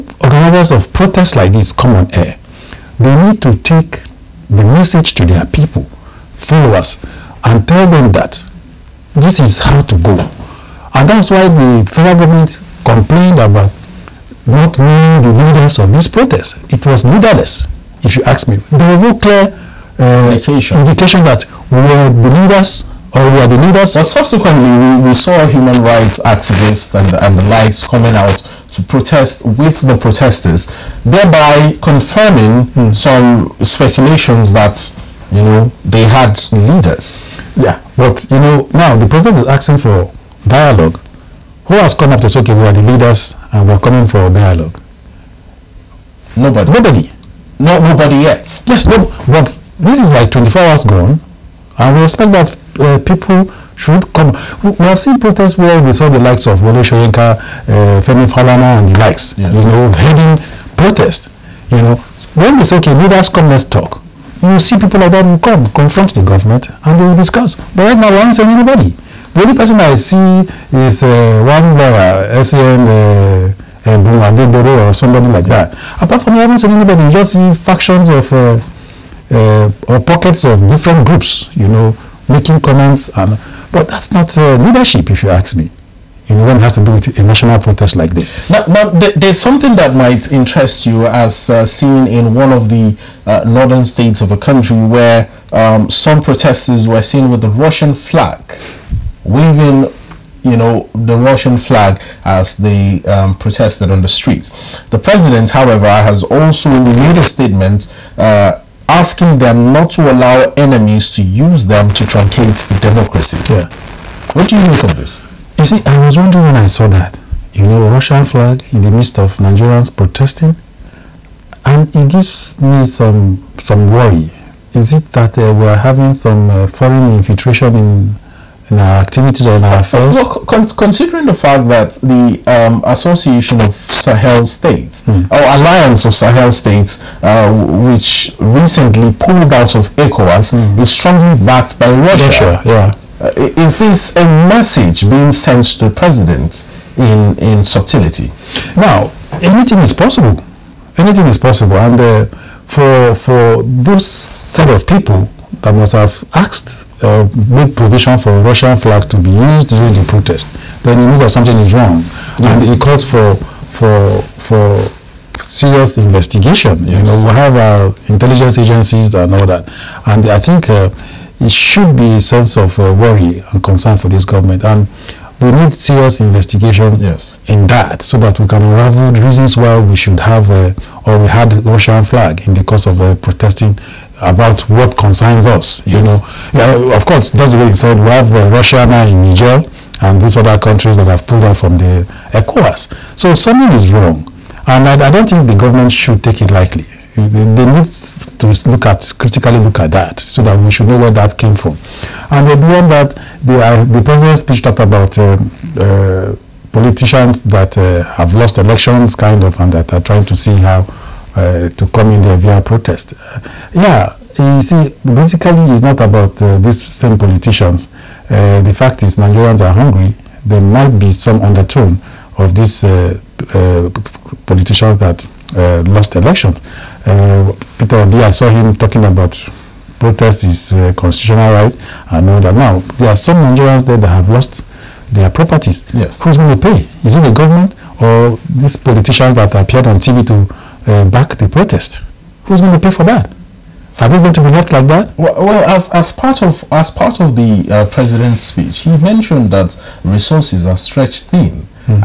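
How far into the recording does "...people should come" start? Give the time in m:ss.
0:53.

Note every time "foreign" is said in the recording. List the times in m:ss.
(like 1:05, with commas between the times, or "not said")
2:06.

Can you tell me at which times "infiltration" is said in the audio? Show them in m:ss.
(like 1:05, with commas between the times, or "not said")
2:07.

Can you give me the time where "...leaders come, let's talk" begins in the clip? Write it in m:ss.
1:02.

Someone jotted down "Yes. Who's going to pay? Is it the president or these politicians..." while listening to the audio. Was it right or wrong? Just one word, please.
wrong.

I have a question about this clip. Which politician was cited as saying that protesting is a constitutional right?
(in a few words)
Peter Obi.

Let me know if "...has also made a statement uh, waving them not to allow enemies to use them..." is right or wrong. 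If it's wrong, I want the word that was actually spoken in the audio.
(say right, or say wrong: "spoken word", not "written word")
wrong: "asking", not "waving".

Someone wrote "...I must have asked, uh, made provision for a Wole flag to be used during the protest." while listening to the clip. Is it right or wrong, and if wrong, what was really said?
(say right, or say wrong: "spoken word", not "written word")
wrong: "Russian", not "Wole".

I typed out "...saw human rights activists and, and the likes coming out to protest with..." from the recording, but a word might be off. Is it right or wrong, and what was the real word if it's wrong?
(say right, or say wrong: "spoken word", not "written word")
right.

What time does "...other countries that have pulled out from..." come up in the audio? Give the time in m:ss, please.
3:10.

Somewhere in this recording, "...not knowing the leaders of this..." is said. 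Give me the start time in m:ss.
0:14.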